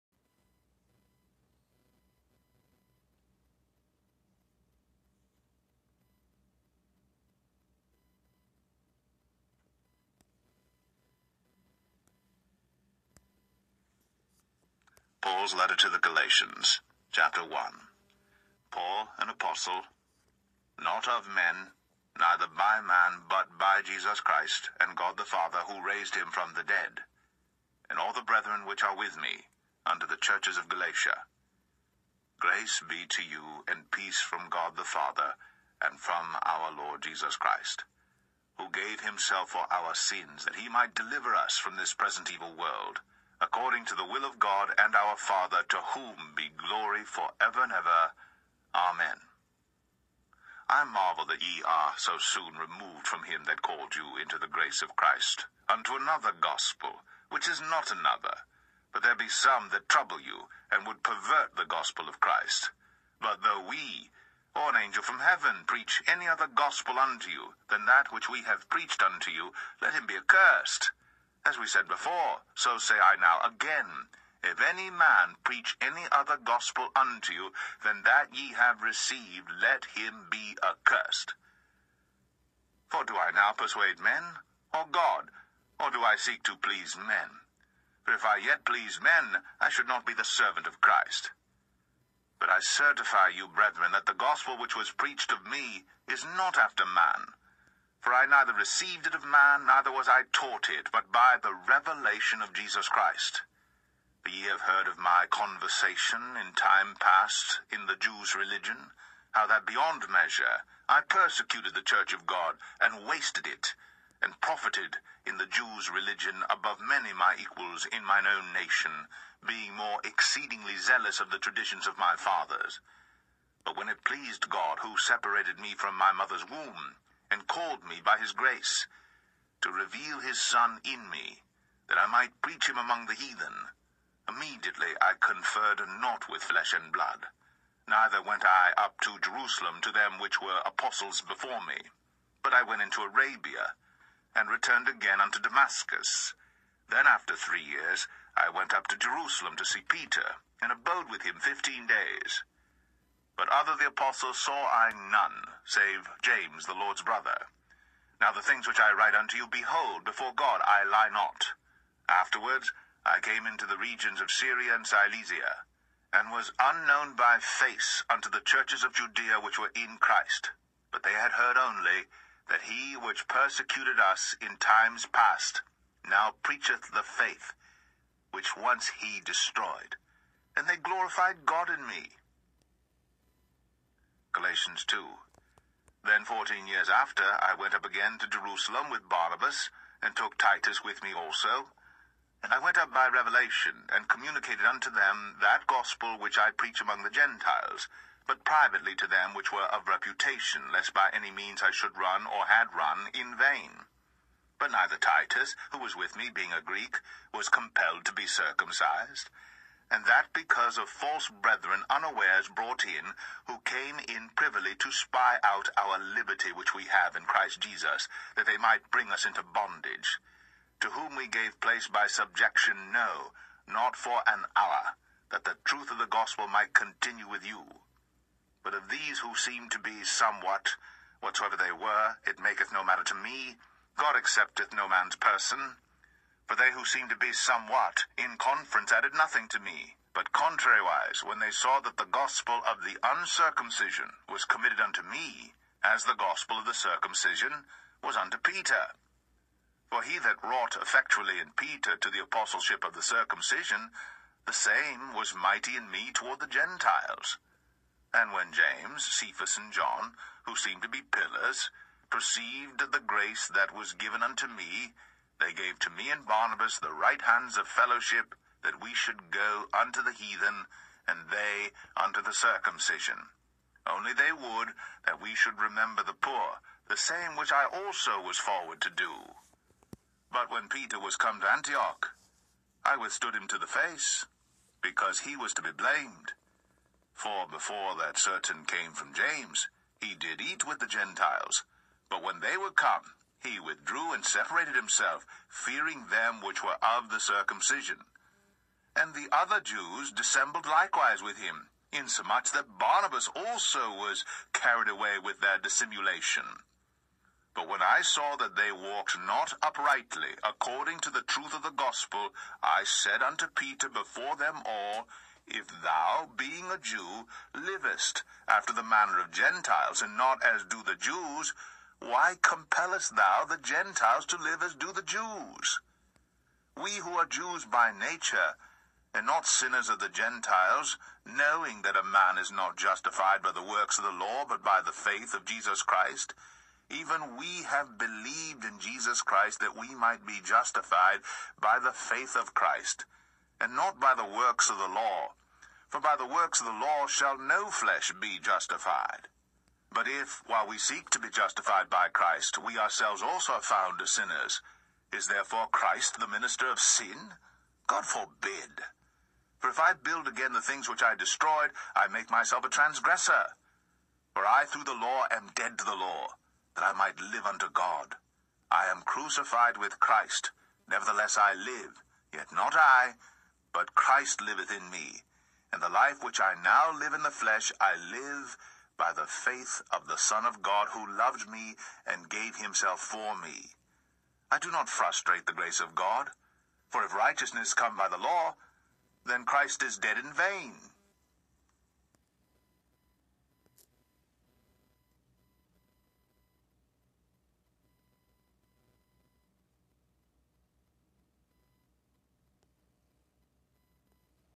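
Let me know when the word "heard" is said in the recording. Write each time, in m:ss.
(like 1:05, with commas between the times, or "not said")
1:44, 2:51.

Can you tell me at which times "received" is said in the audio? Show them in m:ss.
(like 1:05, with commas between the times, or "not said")
1:18, 1:38.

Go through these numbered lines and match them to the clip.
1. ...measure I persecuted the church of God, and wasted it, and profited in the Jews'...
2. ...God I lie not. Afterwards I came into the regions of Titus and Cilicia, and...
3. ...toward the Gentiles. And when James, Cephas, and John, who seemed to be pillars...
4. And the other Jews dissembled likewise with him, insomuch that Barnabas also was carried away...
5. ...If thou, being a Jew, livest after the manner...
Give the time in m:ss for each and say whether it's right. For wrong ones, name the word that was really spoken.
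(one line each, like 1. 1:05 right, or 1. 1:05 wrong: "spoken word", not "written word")
1. 1:50 right
2. 2:40 wrong: "Syria", not "Titus"
3. 4:16 right
4. 4:58 right
5. 5:15 right.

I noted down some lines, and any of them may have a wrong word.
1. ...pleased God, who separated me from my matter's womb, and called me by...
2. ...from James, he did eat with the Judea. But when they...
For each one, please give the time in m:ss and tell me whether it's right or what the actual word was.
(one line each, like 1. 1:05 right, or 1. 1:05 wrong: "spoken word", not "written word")
1. 2:04 wrong: "mother", not "matter"
2. 4:48 wrong: "Gentiles", not "Judea".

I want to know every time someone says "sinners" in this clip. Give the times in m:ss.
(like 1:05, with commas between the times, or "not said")
5:29, 5:54.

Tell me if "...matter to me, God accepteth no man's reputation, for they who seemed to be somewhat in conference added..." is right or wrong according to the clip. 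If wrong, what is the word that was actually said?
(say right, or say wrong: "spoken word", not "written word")
wrong: "person", not "reputation".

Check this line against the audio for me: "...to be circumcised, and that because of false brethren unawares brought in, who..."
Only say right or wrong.
right.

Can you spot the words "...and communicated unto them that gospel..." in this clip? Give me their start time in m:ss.
3:13.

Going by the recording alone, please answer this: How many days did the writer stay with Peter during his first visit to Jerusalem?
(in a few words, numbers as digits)
15.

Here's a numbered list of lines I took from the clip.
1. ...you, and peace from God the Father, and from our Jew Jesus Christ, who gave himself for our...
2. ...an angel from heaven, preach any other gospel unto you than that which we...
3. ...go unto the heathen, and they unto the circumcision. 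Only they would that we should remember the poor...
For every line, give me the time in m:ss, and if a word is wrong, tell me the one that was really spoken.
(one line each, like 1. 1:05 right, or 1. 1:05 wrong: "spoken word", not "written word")
1. 0:33 wrong: "Lord", not "Jew"
2. 1:04 right
3. 4:29 right.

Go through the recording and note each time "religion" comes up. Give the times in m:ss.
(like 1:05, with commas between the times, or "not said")
1:48, 1:55.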